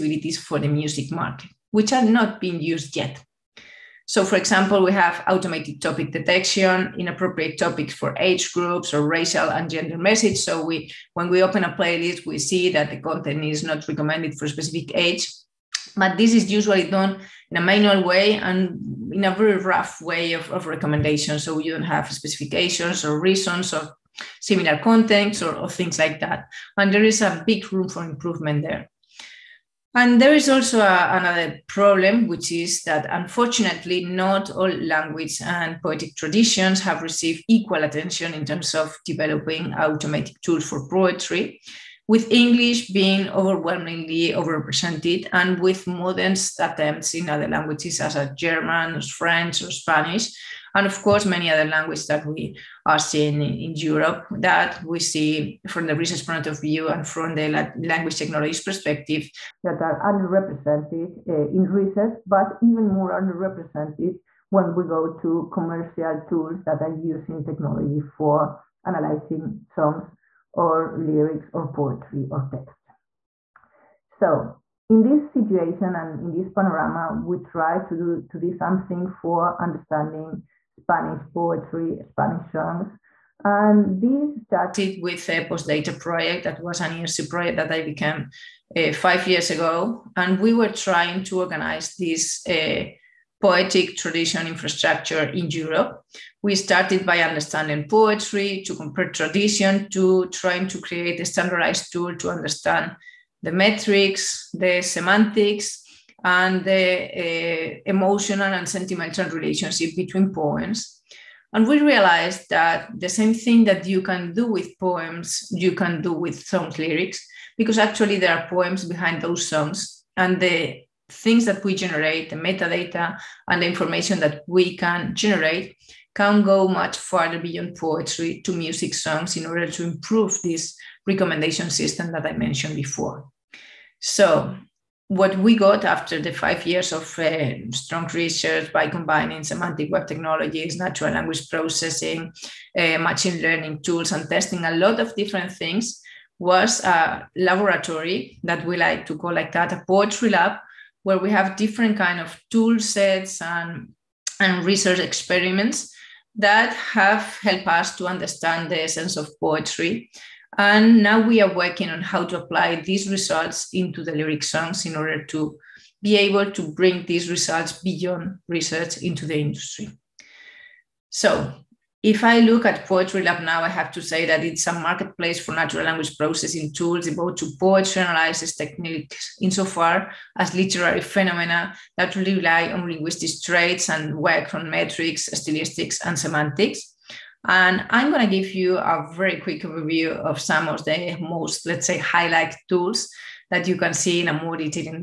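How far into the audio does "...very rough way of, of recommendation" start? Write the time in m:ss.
0:19.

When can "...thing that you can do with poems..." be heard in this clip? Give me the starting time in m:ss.
1:53.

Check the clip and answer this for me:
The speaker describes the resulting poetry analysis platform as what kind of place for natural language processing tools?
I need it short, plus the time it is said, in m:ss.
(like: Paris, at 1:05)
a marketplace, at 2:54.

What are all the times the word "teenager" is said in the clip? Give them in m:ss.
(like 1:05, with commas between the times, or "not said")
not said.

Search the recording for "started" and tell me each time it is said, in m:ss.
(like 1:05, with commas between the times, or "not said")
1:24, 1:36.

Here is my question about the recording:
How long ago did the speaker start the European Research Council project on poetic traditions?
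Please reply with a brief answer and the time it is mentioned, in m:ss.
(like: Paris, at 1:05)
5 years ago, at 1:28.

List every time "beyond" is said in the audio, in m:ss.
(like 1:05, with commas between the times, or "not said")
2:07, 2:47.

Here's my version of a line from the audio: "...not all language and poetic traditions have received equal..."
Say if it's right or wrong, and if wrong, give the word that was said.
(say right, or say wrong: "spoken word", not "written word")
right.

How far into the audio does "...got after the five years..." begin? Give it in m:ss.
2:15.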